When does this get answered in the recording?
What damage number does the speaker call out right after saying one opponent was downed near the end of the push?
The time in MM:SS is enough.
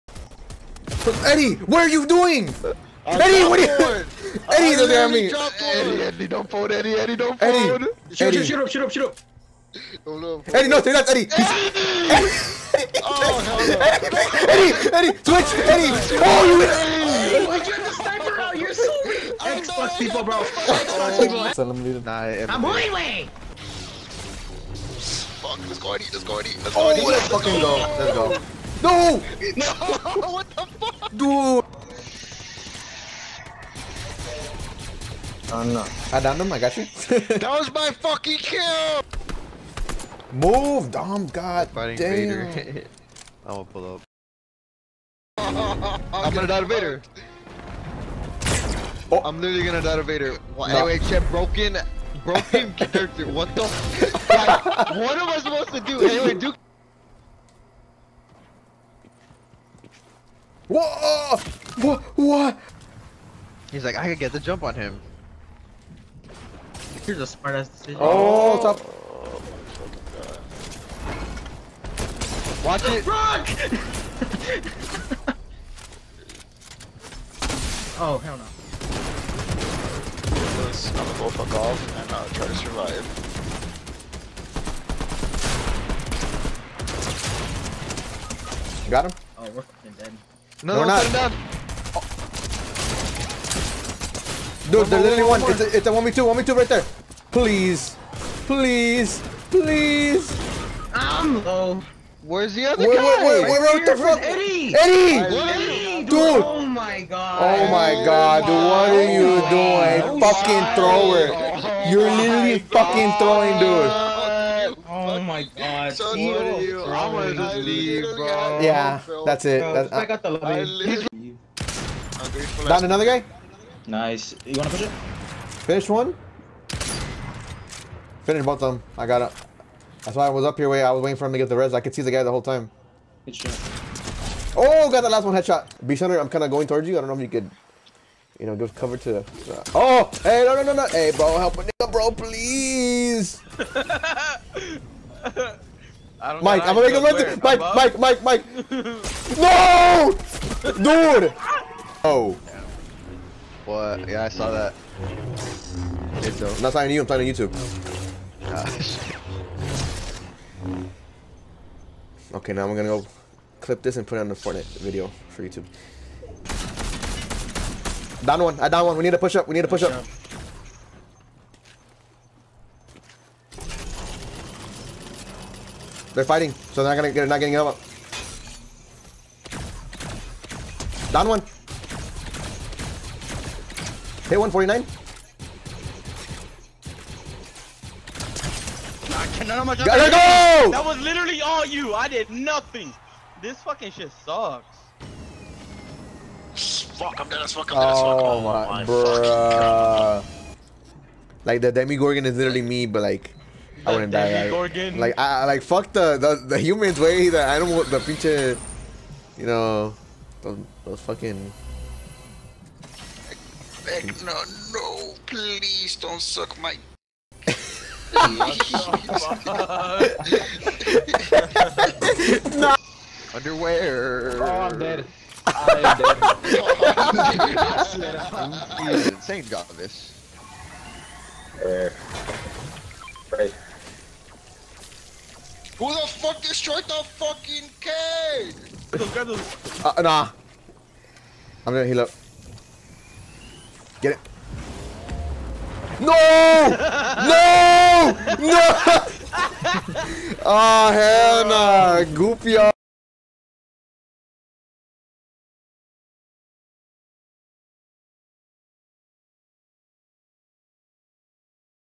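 03:04.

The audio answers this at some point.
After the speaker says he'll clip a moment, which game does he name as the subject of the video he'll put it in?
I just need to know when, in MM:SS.
02:44.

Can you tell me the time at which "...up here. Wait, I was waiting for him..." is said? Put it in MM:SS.
02:10.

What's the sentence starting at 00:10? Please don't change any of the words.
Oh, no, Eddie, no, three nuts, Eddie.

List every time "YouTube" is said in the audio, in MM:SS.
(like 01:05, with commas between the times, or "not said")
02:37, 02:45.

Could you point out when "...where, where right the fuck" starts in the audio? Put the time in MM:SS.
01:43.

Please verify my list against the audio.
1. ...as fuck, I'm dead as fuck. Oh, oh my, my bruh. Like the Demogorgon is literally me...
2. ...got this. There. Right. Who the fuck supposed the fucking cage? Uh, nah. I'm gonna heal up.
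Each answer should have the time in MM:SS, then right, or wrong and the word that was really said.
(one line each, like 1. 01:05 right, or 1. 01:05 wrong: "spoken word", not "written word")
1. 03:17 right
2. 03:49 wrong: "destroyed", not "supposed".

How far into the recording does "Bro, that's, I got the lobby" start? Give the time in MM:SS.
01:59.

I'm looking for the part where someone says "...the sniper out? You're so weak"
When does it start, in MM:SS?
00:17.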